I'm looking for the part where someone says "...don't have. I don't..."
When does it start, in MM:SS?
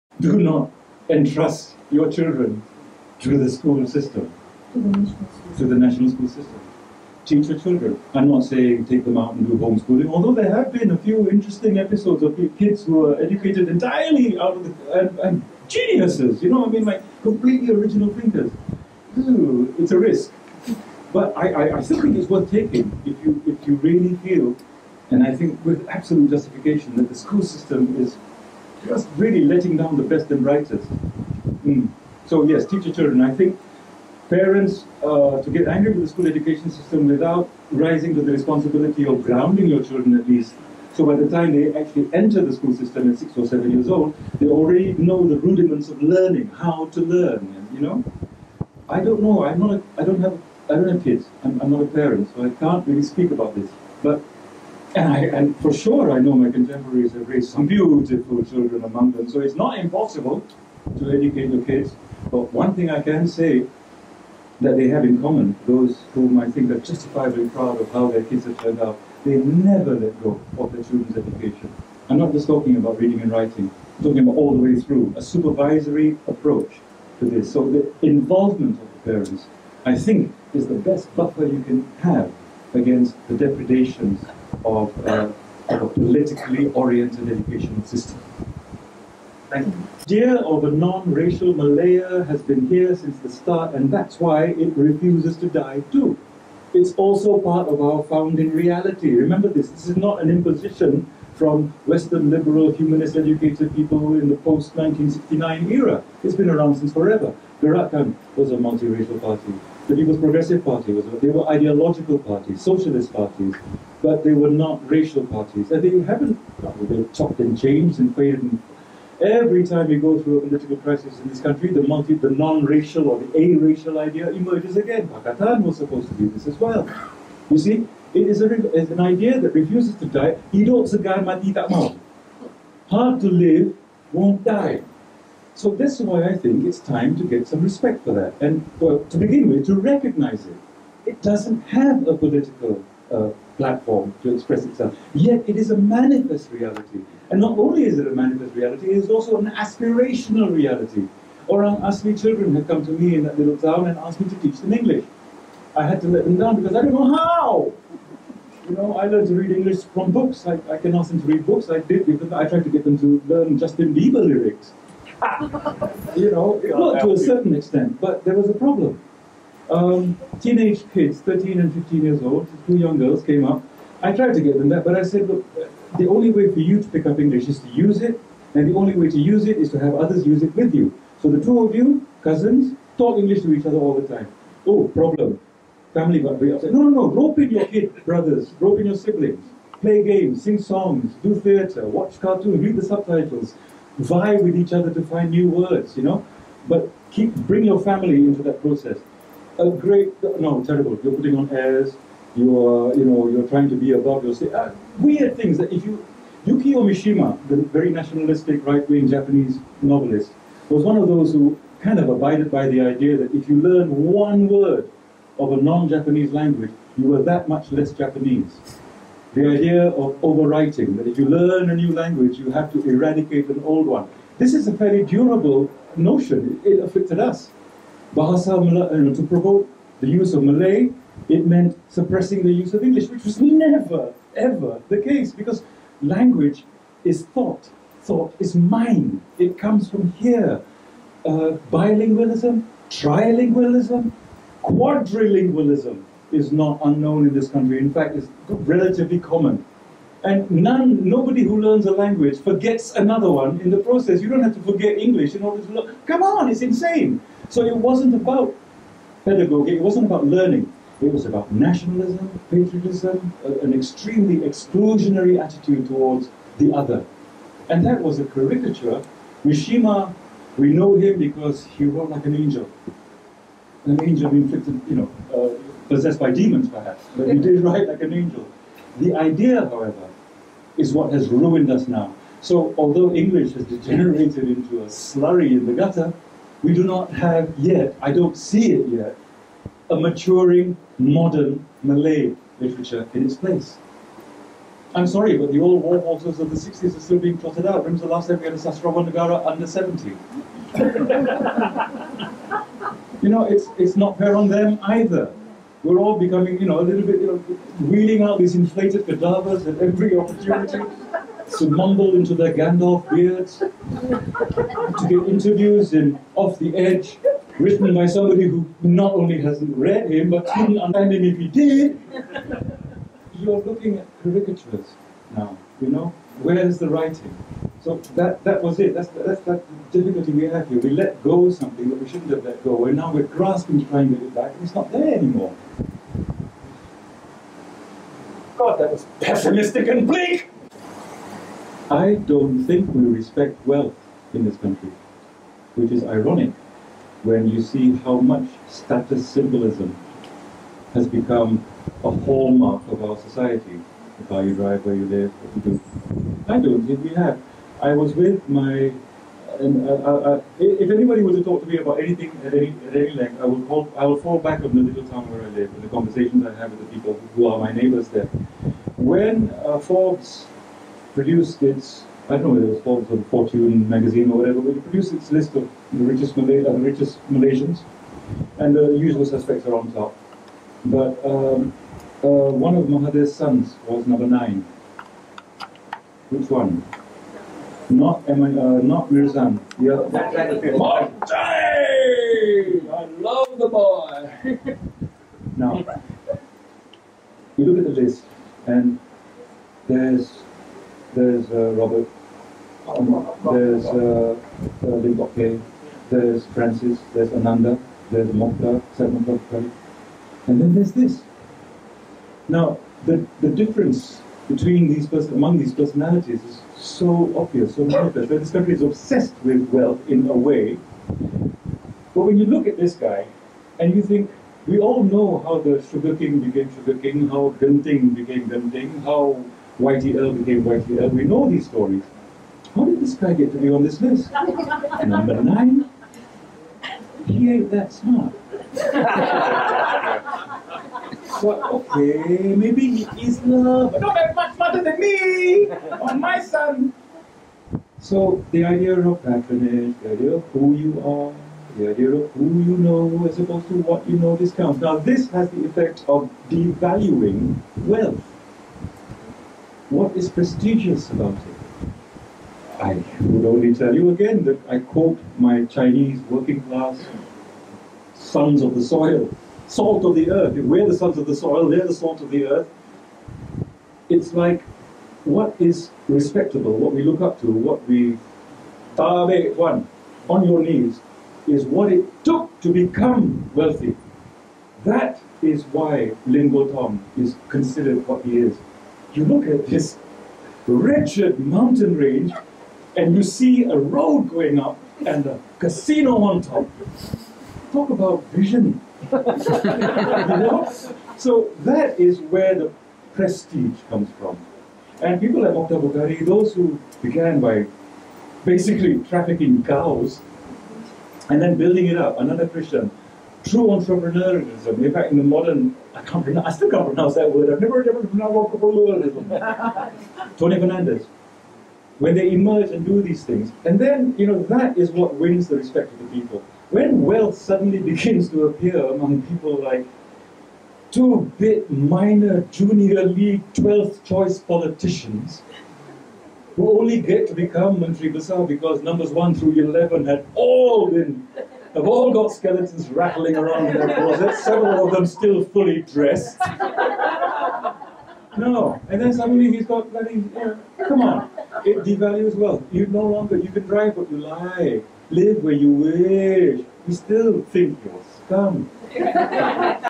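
00:50.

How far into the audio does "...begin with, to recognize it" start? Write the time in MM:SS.
02:19.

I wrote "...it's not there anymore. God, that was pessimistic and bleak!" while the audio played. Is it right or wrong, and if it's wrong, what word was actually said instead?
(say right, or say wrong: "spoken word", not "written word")
right.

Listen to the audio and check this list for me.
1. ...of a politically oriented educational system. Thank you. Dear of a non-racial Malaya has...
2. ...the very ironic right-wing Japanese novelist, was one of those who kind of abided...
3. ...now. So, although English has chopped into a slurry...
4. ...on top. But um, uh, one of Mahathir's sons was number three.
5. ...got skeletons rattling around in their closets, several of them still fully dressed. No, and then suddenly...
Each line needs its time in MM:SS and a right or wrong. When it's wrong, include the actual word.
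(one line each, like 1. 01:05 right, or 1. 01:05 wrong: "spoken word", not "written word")
1. 01:25 right
2. 03:27 wrong: "nationalistic", not "ironic"
3. 04:41 wrong: "degenerated", not "chopped"
4. 06:19 wrong: "nine", not "three"
5. 09:02 right.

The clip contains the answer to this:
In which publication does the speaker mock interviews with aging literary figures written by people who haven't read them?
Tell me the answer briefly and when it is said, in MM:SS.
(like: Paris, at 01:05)
Off the Edge, at 05:16.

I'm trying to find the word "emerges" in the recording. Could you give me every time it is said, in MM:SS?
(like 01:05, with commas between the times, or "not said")
02:04, 08:42.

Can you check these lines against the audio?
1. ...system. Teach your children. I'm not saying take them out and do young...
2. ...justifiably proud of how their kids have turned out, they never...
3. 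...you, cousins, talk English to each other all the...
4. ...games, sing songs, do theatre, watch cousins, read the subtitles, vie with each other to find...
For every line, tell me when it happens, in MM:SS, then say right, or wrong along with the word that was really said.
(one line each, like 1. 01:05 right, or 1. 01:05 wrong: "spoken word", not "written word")
1. 00:06 wrong: "homeschooling", not "young"
2. 01:06 right
3. 03:01 right
4. 03:10 wrong: "cartoons", not "cousins".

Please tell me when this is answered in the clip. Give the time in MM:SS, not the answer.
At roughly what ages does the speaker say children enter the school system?
00:43.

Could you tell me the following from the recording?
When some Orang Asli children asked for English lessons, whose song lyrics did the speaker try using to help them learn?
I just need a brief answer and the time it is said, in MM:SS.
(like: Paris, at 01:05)
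Justin Bieber, at 02:43.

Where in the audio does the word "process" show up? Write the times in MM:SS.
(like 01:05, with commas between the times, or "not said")
03:18, 04:13.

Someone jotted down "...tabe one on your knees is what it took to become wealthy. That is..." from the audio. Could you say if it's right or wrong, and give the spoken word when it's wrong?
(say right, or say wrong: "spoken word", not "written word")
right.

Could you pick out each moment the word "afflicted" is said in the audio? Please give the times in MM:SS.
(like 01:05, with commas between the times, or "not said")
03:46.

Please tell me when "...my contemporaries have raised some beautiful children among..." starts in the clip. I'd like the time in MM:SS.
00:56.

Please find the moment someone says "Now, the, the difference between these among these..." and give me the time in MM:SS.
06:52.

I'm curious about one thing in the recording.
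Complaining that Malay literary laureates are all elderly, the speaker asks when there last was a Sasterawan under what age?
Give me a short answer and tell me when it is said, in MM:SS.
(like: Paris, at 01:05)
70, at 04:59.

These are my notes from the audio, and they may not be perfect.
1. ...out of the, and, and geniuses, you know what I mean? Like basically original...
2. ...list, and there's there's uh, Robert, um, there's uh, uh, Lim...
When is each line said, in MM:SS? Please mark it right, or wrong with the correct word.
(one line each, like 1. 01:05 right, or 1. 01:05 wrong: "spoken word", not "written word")
1. 00:14 wrong: "completely", not "basically"
2. 06:38 right.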